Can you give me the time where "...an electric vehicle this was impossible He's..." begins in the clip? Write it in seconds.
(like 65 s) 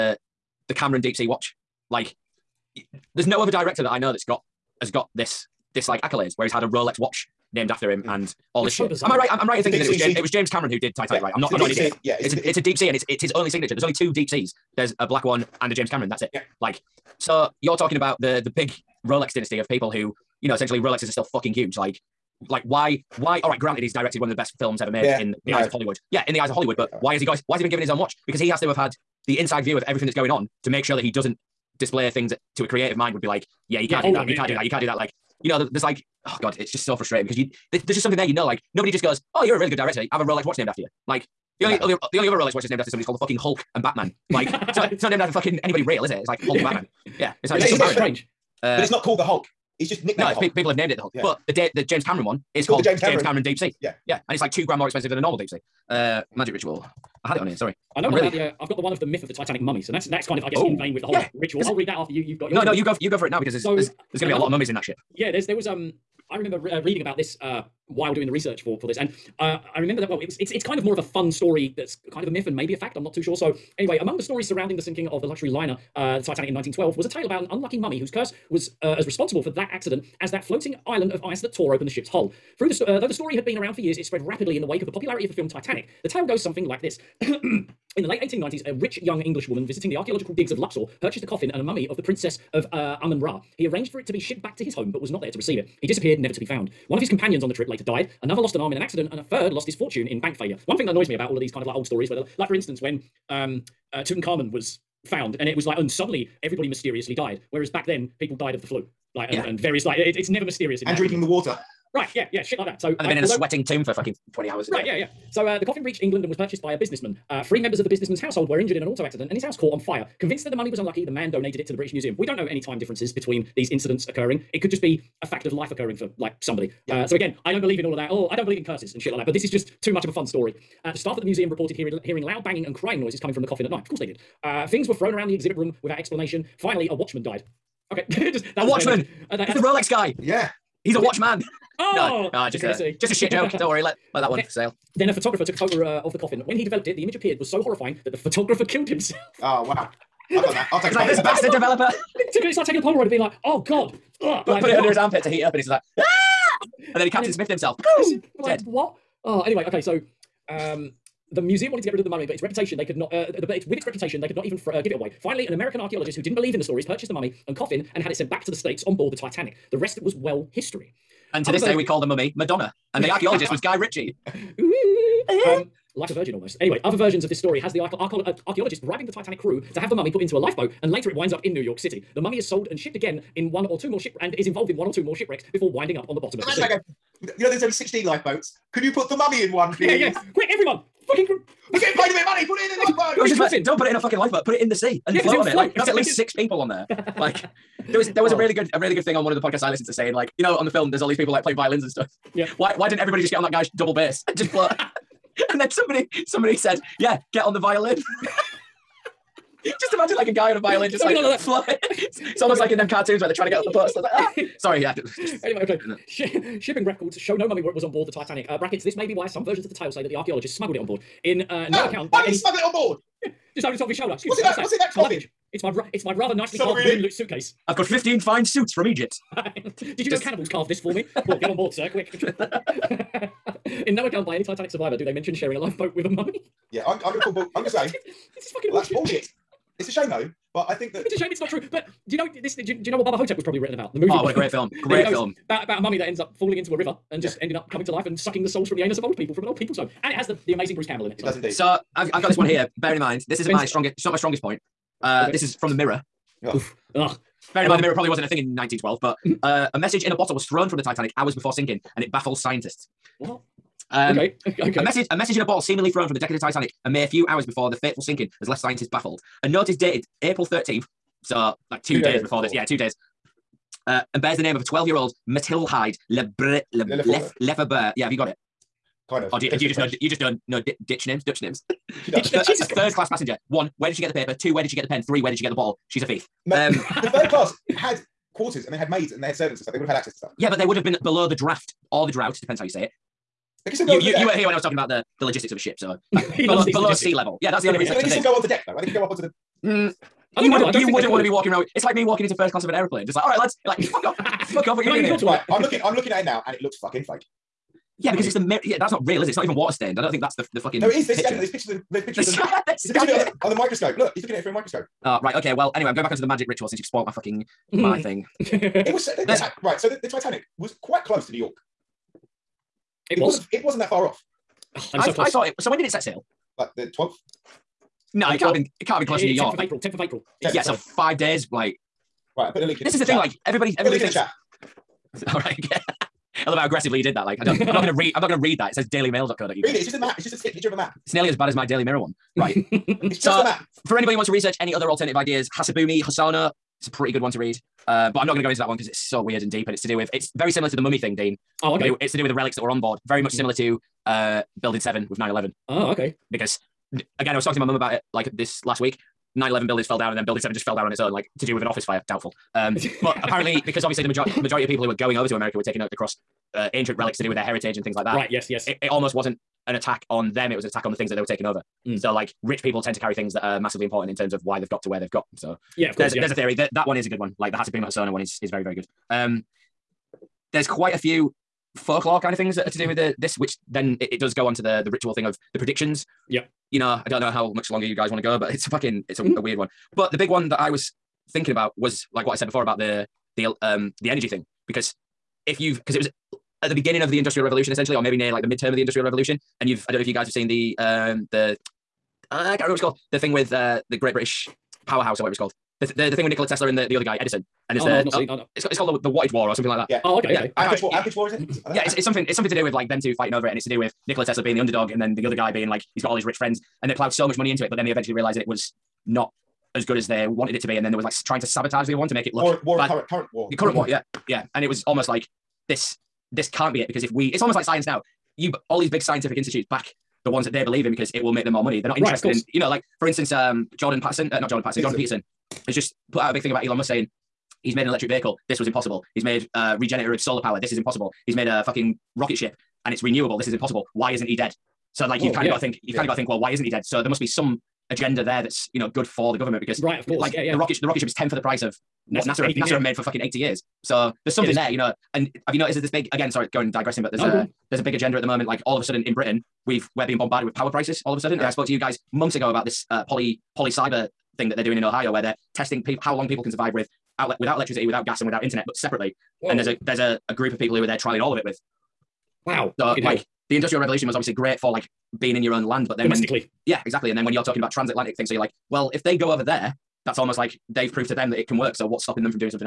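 437 s.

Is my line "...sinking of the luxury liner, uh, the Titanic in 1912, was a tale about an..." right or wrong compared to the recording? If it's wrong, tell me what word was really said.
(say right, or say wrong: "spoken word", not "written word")
right.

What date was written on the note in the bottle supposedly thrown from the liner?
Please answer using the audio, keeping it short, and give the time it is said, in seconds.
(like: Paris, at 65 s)
April 13th, at 270 s.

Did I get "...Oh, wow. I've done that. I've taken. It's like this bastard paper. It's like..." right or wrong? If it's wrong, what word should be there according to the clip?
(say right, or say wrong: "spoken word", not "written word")
wrong: "developer", not "paper".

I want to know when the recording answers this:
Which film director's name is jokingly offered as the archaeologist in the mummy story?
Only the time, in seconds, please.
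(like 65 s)
173 s.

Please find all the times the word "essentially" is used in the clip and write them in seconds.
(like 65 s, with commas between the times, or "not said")
20 s, 397 s.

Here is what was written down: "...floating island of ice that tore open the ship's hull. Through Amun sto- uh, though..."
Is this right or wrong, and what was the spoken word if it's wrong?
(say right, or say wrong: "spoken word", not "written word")
wrong: "The", not "Amun".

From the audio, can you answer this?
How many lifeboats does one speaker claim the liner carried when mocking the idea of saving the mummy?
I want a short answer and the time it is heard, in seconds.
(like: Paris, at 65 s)
16, at 187 s.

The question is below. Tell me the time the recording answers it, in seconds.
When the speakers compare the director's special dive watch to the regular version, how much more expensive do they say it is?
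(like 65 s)
54 s.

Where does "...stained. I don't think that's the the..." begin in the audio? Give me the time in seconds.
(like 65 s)
309 s.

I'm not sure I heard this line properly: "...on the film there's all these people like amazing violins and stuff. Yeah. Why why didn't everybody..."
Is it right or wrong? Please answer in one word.
wrong.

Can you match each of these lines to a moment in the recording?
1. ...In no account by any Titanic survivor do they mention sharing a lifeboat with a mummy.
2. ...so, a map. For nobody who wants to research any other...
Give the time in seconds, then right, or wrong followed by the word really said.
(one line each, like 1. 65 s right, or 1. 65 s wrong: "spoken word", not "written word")
1. 233 s right
2. 343 s wrong: "anybody", not "nobody".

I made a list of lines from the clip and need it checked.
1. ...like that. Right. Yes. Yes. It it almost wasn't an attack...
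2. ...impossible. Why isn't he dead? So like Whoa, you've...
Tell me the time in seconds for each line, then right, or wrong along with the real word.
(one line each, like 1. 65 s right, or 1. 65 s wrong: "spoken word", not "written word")
1. 367 s right
2. 443 s right.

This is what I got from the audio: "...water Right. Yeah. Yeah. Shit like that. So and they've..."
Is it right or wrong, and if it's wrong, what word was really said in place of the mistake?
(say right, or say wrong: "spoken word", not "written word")
right.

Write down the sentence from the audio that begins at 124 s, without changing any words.
It could just be a fact of life occurring for like somebody.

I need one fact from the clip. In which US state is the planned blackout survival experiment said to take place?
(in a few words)
Ohio.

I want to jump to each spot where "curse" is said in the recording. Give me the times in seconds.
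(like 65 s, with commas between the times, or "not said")
78 s, 128 s.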